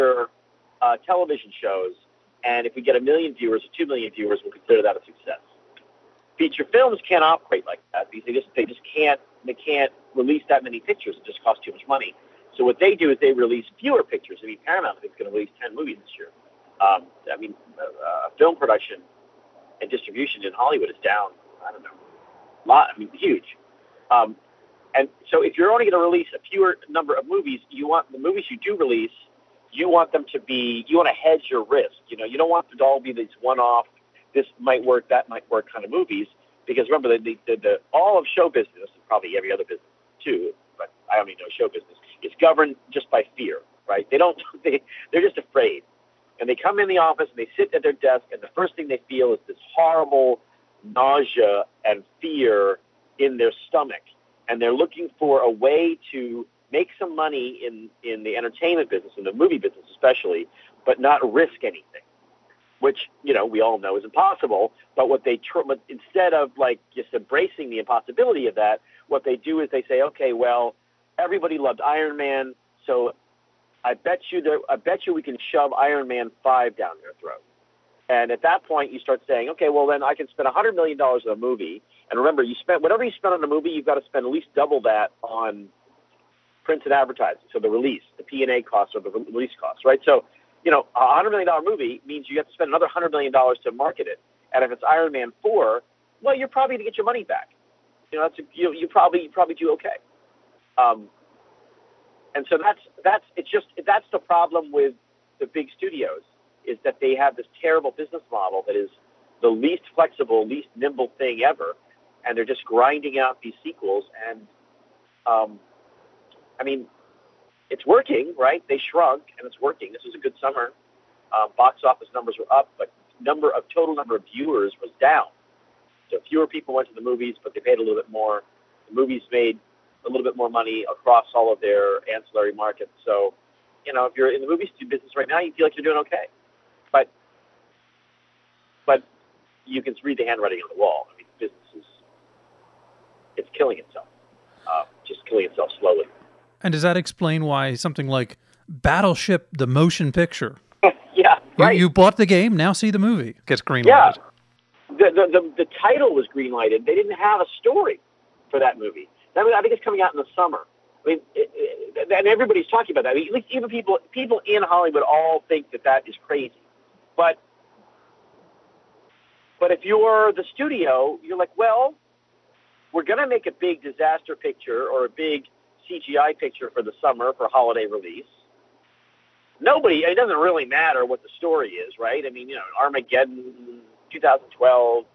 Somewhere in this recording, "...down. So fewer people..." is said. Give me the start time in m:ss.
2:04.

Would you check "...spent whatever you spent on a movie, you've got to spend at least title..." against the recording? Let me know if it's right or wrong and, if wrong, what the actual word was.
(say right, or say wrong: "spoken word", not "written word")
wrong: "double", not "title".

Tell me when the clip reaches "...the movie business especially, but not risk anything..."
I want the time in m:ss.
0:59.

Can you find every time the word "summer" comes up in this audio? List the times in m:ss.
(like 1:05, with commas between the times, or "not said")
2:00, 2:40, 2:56.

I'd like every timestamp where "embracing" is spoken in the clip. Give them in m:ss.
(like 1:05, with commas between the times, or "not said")
1:07.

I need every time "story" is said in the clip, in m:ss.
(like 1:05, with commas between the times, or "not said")
2:37, 3:01.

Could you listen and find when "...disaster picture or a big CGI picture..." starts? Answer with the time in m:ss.
2:53.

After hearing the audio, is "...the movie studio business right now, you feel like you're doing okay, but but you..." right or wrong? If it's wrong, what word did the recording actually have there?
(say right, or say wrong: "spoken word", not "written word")
right.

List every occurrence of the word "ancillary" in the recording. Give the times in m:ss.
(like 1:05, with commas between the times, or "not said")
2:12.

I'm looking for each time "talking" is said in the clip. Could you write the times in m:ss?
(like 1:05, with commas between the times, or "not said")
2:42.